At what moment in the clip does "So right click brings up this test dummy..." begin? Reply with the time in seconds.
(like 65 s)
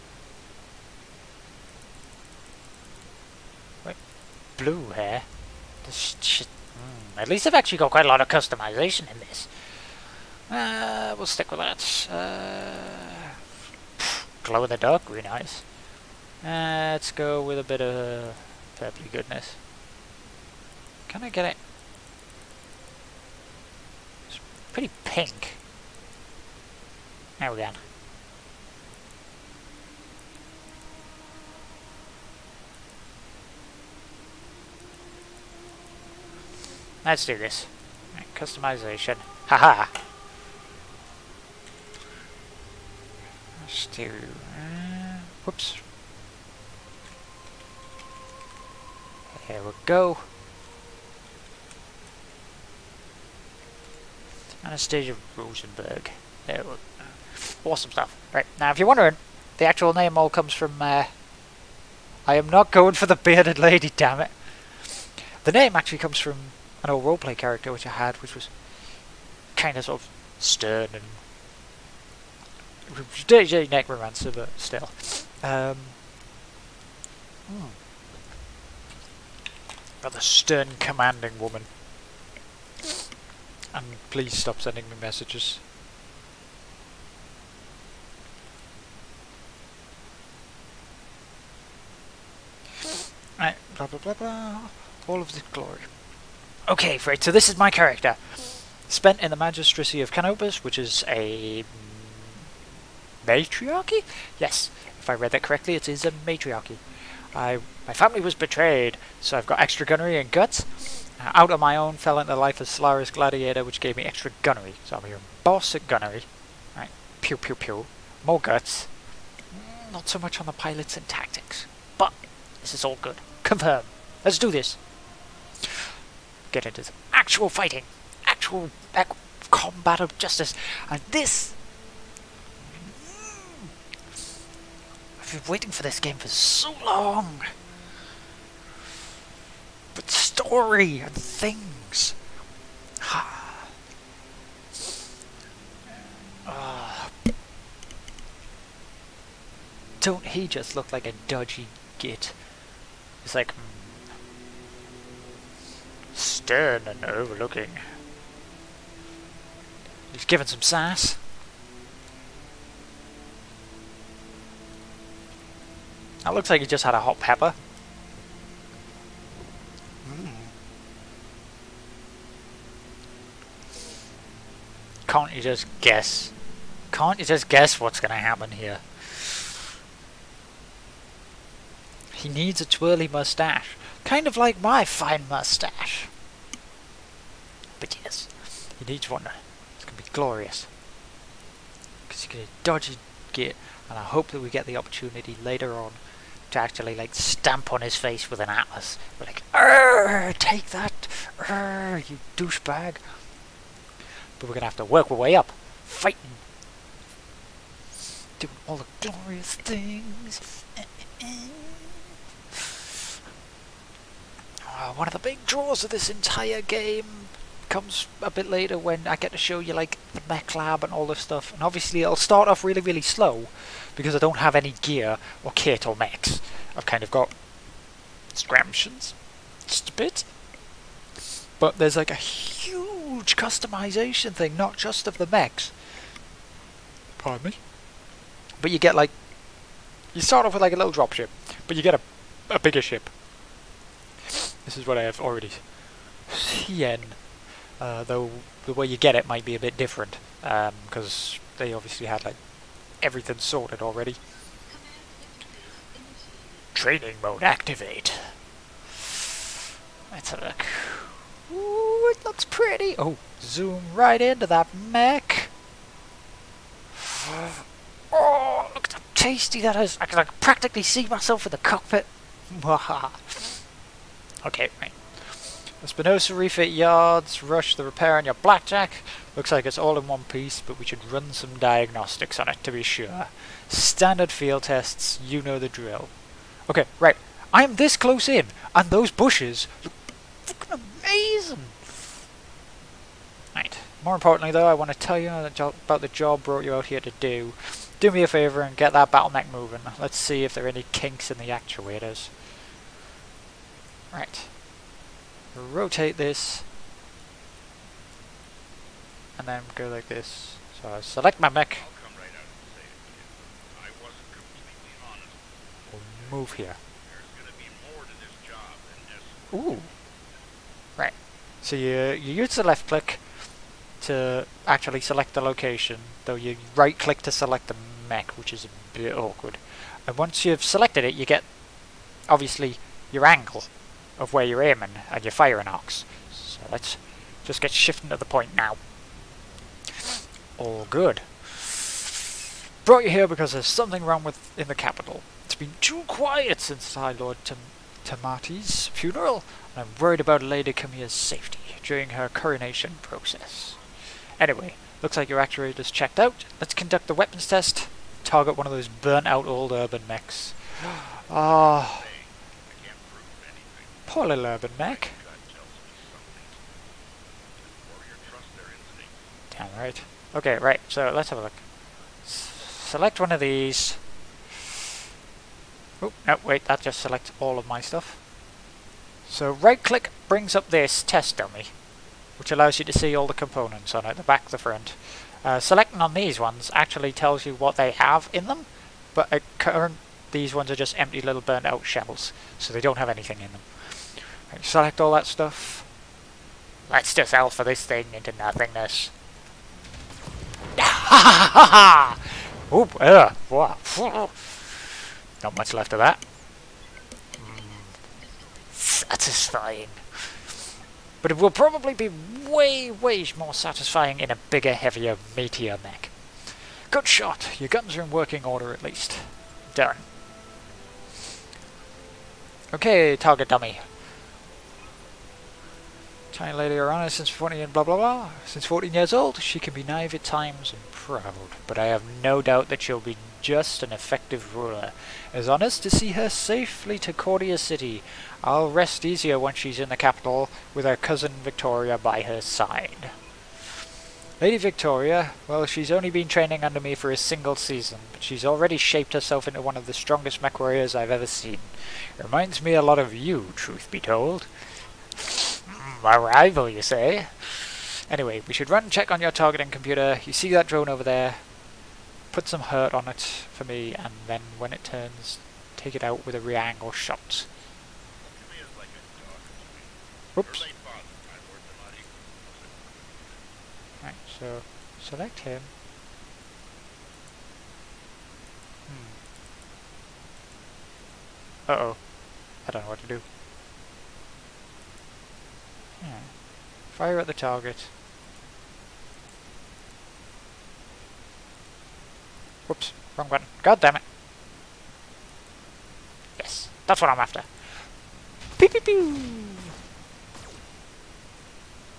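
379 s.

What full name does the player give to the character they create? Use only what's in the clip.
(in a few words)
Anastasia Rosenberg.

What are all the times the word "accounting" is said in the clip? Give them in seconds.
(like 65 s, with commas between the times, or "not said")
not said.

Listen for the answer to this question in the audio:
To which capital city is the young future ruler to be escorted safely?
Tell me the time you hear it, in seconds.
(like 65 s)
437 s.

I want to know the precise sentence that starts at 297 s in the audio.
Do me a favour and get that battle mech moving.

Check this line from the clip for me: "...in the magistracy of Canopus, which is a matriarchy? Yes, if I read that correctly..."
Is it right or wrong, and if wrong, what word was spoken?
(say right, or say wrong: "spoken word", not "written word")
right.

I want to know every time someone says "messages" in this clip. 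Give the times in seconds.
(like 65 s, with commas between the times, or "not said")
85 s.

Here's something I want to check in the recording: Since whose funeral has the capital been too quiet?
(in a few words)
High Lord Tamati.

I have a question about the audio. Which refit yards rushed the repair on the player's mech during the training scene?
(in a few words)
Spinoza refit yards.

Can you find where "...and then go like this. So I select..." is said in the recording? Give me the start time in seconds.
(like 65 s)
309 s.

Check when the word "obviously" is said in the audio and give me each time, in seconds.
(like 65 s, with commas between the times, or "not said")
221 s, 251 s, 332 s.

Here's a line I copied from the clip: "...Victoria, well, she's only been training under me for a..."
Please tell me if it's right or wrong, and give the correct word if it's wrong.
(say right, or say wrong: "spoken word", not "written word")
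right.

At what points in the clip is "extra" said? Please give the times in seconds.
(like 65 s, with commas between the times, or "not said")
109 s, 114 s.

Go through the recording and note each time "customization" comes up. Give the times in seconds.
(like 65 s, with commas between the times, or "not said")
8 s, 38 s, 233 s.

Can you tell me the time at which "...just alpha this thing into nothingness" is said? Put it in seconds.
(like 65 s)
397 s.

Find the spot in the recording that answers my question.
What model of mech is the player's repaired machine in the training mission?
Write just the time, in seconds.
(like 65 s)
278 s.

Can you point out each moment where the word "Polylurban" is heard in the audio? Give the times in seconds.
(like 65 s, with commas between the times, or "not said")
364 s.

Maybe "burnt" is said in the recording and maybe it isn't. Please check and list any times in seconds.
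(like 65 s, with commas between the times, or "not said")
358 s, 391 s.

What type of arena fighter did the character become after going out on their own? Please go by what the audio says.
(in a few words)
Solaris Gladiator.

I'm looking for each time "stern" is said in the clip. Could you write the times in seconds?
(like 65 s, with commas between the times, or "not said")
70 s, 80 s, 156 s.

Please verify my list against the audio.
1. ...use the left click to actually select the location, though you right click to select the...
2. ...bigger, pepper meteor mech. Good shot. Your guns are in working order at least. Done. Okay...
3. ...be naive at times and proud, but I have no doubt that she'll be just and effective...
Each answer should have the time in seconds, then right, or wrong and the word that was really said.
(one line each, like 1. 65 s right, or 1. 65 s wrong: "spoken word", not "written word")
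1. 322 s right
2. 414 s wrong: "heavier", not "pepper"
3. 429 s right.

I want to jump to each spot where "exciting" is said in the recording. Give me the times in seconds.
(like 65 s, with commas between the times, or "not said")
not said.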